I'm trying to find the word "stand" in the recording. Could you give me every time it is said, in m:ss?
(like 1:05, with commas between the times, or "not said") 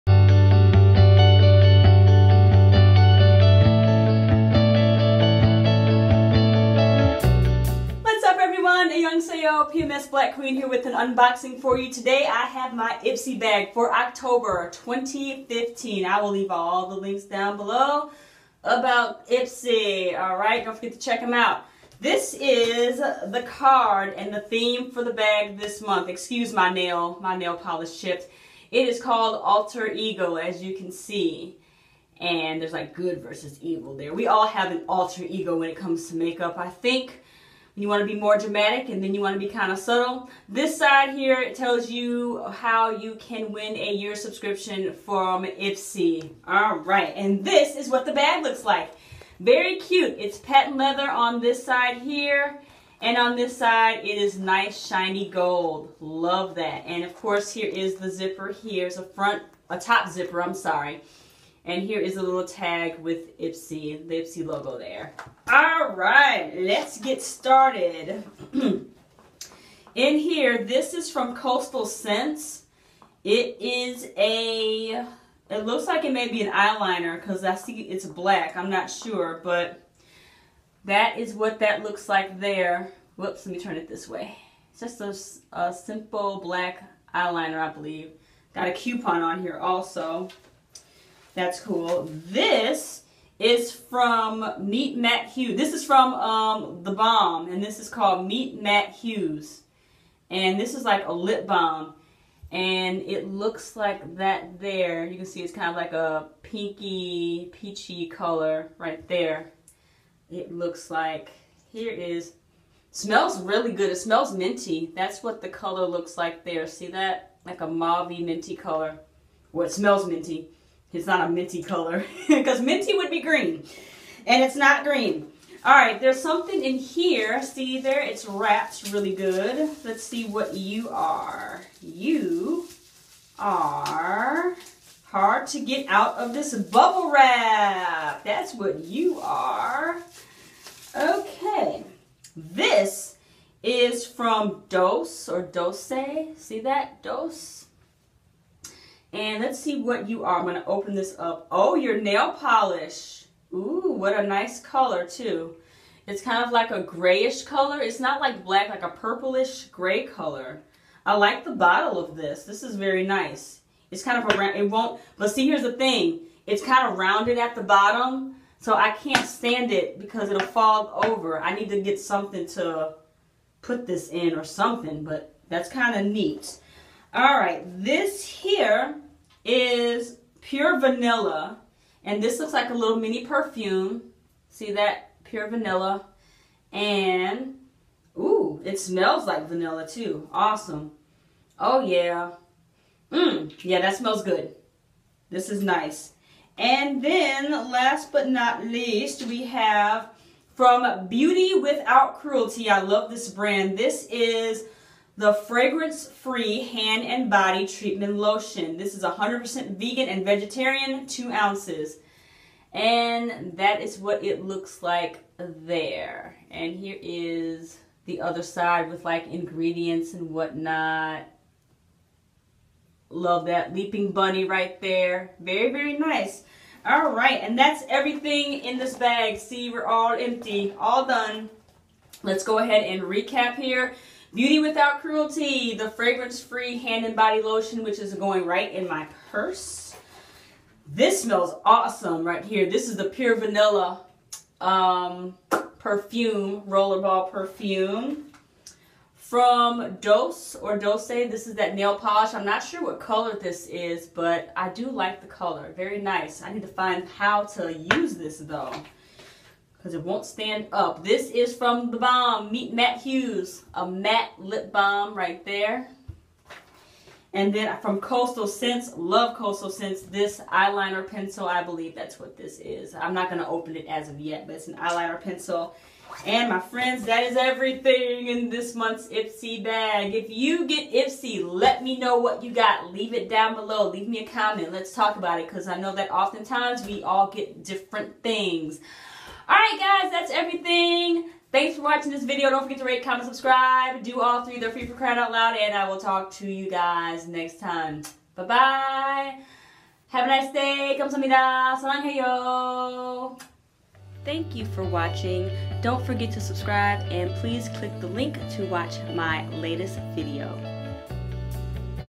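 2:49, 4:20.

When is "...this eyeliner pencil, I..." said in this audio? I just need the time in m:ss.
4:30.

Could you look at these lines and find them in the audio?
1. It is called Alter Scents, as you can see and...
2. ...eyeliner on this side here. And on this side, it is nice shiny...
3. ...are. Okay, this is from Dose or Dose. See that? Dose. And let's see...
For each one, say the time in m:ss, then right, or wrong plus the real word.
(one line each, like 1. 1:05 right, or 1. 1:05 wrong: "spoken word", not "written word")
1. 0:28 wrong: "Ego", not "Scents"
2. 0:50 wrong: "leather", not "eyeliner"
3. 2:19 right.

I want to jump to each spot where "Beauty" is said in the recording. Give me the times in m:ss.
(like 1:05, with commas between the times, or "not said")
3:21, 3:54.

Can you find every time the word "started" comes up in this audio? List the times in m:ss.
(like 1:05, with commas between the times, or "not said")
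1:07.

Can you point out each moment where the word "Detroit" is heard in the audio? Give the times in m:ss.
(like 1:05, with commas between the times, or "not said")
not said.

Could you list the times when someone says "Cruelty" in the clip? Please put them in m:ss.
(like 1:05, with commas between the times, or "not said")
3:22, 3:55.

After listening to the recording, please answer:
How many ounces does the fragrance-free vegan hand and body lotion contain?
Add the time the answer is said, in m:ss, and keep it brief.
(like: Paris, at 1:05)
2, at 3:31.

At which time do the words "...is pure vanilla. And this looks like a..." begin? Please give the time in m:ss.
2:59.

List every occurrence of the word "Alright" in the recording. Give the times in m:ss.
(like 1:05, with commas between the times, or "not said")
0:20, 4:49.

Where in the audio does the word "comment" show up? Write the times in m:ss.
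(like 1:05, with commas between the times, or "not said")
4:44, 4:53.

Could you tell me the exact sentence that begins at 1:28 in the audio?
Got a coupon on here also.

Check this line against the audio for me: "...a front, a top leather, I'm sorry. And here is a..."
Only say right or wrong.
wrong.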